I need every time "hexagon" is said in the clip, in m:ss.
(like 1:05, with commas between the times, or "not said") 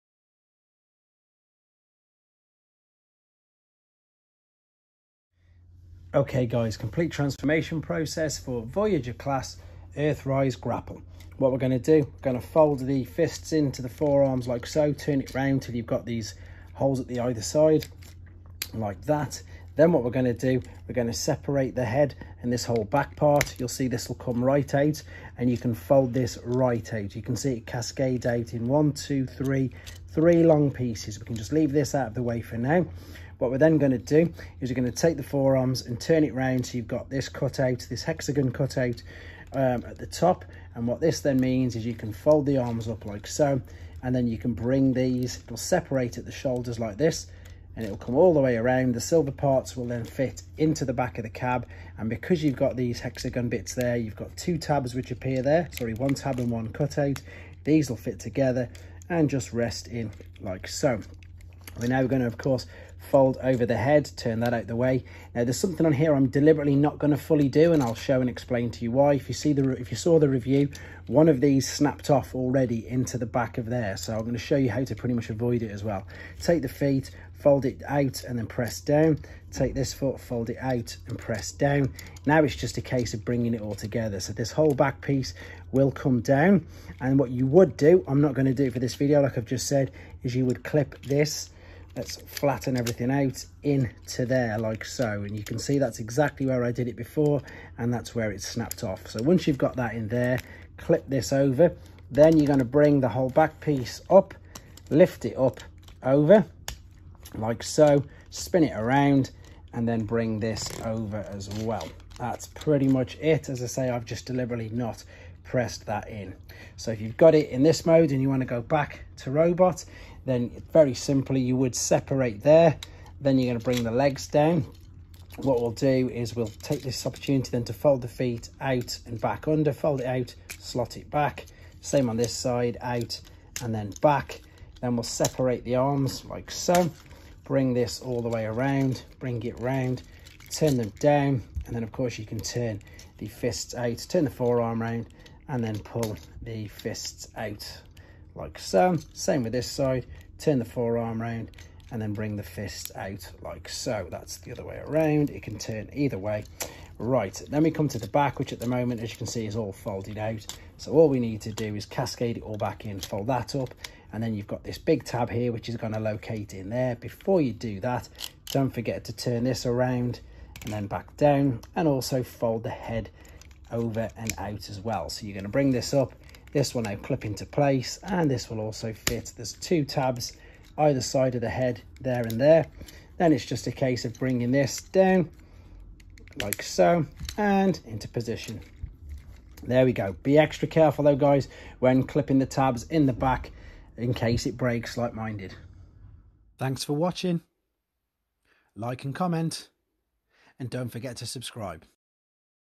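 0:38, 0:52.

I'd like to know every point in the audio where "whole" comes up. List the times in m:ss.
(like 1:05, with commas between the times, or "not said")
0:22, 1:24, 1:43.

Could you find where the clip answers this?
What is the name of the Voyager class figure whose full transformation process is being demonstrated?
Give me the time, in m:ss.
0:09.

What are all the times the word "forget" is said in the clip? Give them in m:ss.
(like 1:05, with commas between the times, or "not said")
2:48, 3:20.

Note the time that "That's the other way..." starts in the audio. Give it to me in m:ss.
2:34.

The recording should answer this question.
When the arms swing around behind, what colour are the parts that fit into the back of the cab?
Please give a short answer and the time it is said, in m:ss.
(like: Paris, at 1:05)
Silver, at 0:49.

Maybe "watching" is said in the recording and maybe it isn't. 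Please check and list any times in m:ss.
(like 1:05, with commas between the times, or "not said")
3:16.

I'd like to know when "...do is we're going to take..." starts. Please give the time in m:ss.
0:33.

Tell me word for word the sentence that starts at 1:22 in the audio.
Now it's just a case of bringing it all together.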